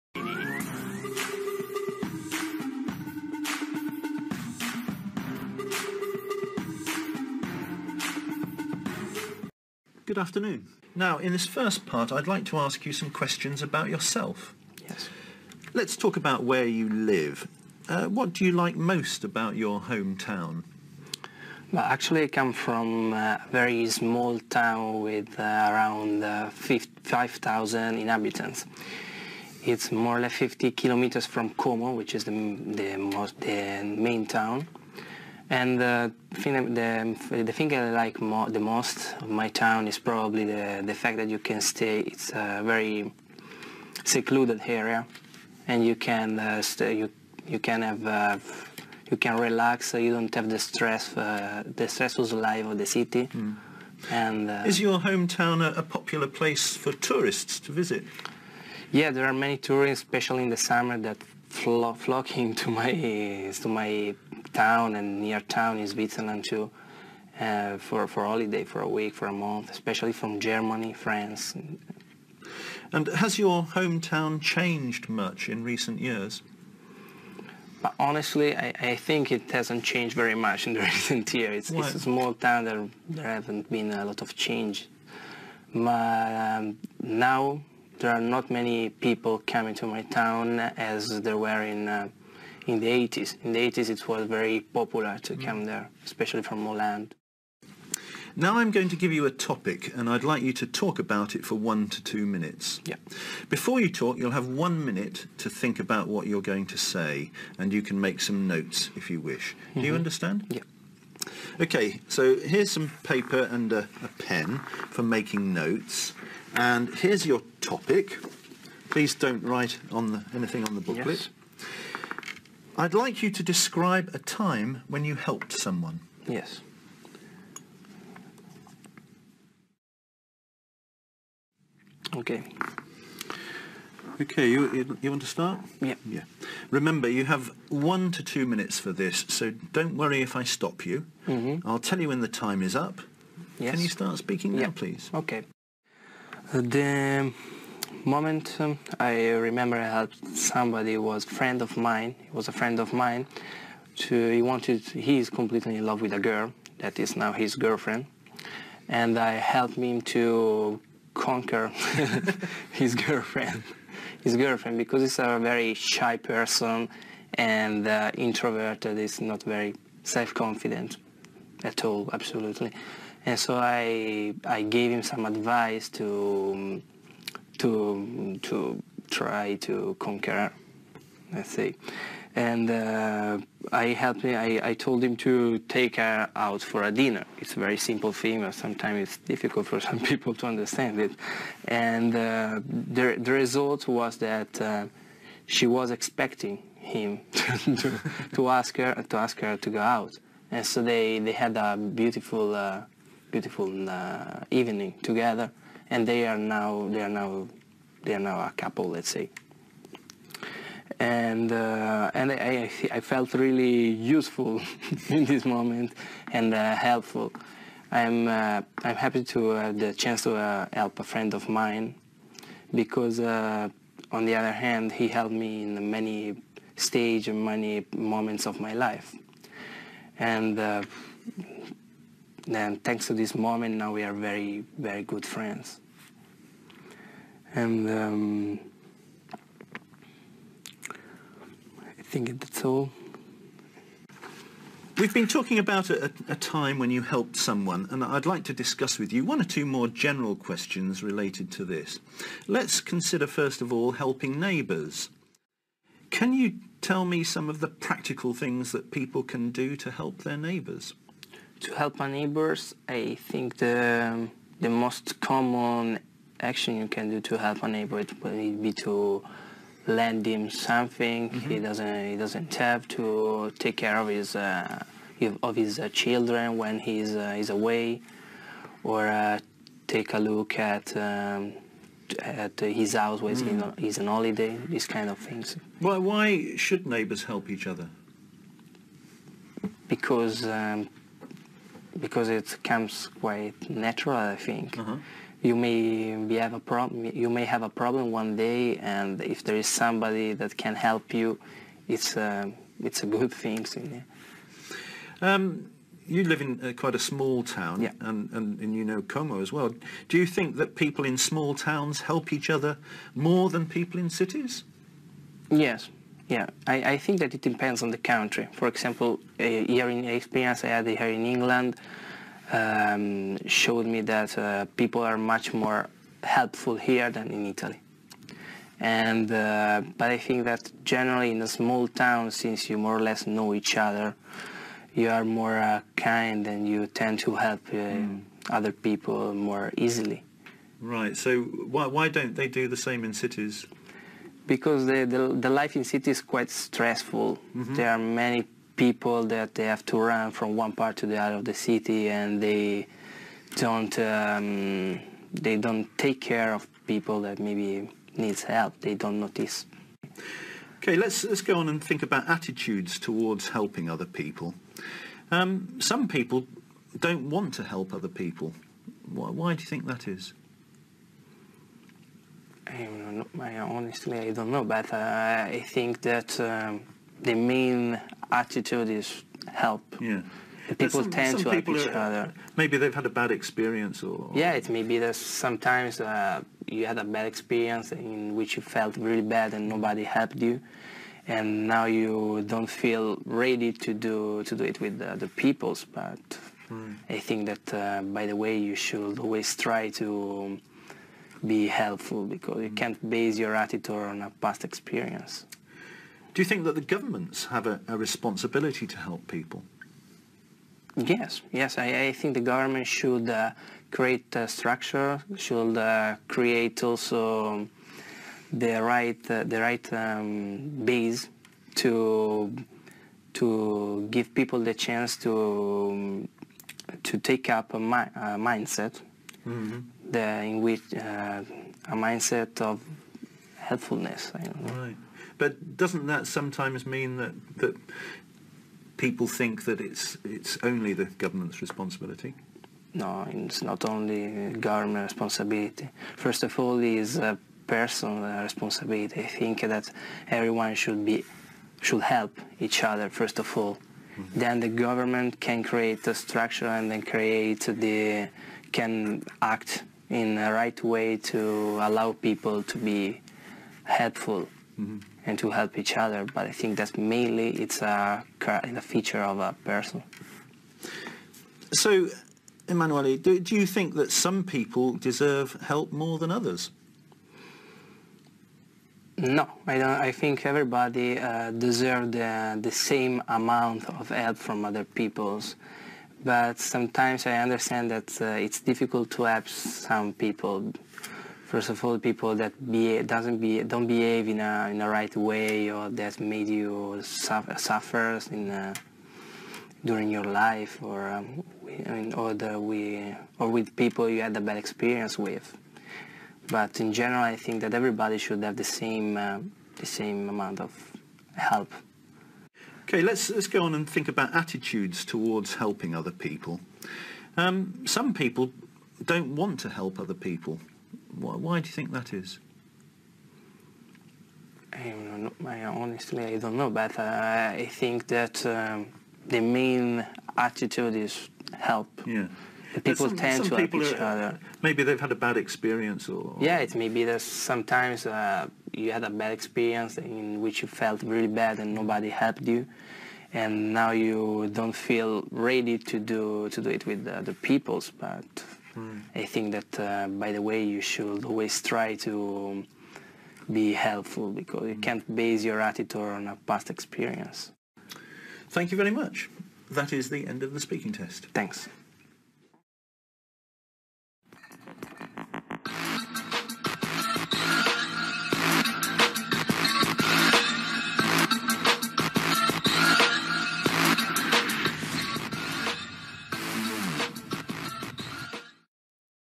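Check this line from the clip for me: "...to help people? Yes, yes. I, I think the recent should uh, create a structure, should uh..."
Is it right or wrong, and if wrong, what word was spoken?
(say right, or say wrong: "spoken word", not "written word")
wrong: "government", not "recent".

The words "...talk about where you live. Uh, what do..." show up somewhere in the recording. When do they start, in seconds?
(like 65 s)
15 s.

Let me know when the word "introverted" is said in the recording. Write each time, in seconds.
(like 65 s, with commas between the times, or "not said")
168 s.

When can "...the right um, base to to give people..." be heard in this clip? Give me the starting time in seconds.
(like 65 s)
419 s.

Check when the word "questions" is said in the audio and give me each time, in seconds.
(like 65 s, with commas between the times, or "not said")
13 s, 250 s.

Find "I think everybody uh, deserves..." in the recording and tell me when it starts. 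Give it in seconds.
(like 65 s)
480 s.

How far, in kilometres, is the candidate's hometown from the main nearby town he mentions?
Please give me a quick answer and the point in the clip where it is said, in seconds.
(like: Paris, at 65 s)
50 kilometres, at 30 s.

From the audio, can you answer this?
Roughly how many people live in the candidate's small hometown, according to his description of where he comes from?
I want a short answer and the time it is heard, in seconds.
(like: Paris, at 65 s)
5,000, at 26 s.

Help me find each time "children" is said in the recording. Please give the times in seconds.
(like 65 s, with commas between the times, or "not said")
276 s.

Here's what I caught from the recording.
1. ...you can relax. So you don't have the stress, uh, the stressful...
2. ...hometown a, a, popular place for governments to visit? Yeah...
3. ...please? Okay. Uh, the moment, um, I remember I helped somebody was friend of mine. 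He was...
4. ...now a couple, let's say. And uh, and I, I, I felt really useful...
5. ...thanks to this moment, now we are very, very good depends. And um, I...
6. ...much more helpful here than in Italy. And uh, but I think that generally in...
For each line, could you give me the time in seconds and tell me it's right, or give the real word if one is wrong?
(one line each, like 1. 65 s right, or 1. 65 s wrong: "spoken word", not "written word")
1. 49 s right
2. 54 s wrong: "tourists", not "governments"
3. 144 s right
4. 208 s right
5. 232 s wrong: "friends", not "depends"
6. 325 s right.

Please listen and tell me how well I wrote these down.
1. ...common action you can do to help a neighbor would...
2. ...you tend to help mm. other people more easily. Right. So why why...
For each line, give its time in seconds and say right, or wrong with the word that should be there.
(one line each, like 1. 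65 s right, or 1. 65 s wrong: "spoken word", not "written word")
1. 265 s right
2. 336 s right.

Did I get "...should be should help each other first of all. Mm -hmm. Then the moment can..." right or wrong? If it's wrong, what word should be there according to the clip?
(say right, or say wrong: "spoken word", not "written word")
wrong: "government", not "moment".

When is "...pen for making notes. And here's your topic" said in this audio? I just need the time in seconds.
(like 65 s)
114 s.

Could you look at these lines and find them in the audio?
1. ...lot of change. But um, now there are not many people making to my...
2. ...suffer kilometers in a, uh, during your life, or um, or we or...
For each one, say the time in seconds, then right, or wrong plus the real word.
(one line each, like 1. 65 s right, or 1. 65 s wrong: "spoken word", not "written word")
1. 84 s wrong: "coming", not "making"
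2. 497 s wrong: "suffers", not "kilometers".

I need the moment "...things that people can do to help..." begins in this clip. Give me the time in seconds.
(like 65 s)
258 s.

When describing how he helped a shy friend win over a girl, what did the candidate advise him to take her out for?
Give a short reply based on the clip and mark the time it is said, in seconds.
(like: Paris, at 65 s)
dinner, at 186 s.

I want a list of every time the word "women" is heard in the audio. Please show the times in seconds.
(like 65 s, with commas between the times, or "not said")
not said.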